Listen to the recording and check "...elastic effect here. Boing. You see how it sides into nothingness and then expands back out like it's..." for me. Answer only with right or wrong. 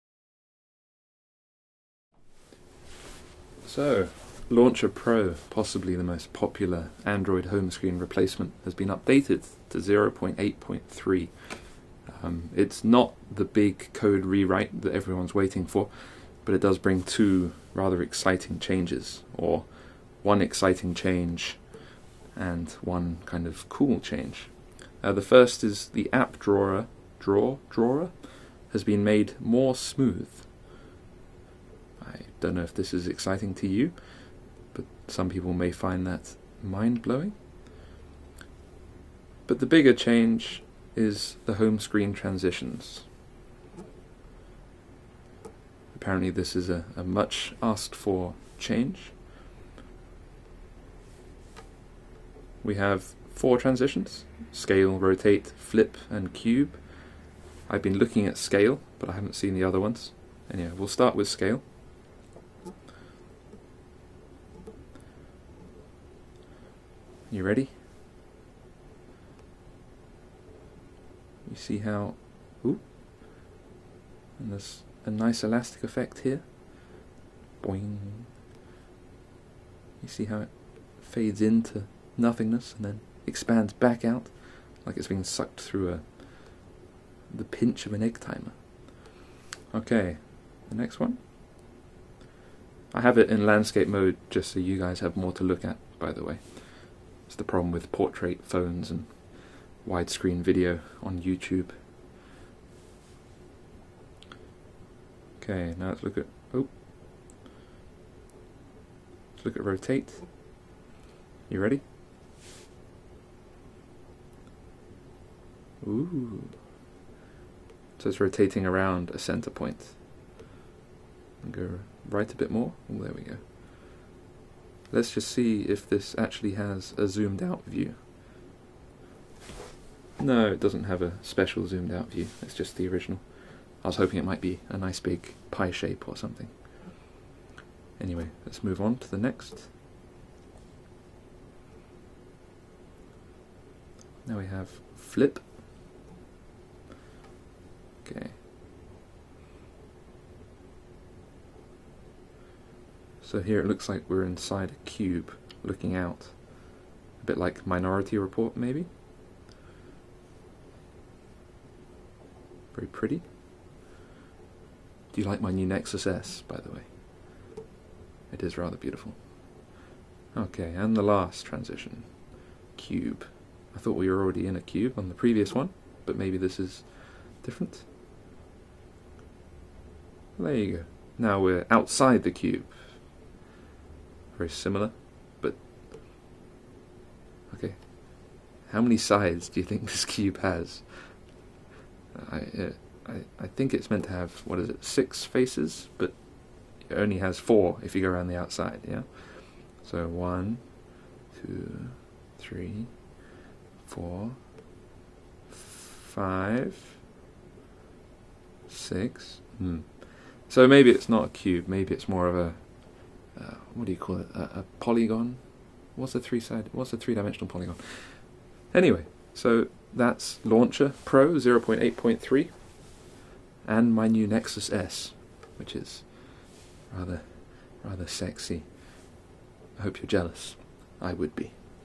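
wrong.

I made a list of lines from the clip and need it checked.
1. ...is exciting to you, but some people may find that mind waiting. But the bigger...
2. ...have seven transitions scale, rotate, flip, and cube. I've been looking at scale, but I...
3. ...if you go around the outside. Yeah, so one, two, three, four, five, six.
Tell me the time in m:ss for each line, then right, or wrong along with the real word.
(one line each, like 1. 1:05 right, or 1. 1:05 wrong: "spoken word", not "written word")
1. 0:32 wrong: "blowing", not "waiting"
2. 0:52 wrong: "four", not "seven"
3. 3:17 right.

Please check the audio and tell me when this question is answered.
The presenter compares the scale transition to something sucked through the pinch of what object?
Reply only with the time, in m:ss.
1:28.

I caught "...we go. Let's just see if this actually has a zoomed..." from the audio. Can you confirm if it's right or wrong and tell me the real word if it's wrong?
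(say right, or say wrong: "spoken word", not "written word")
right.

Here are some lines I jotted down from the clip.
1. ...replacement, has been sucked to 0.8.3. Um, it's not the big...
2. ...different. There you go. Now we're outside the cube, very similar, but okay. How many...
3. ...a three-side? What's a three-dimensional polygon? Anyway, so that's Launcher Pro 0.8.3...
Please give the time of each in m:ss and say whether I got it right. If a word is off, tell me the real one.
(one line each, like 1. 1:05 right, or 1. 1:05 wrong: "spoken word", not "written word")
1. 0:07 wrong: "updated", not "sucked"
2. 2:57 right
3. 3:36 right.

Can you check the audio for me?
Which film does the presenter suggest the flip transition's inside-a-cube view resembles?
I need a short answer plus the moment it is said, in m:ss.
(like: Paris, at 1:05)
Minority Report, at 2:37.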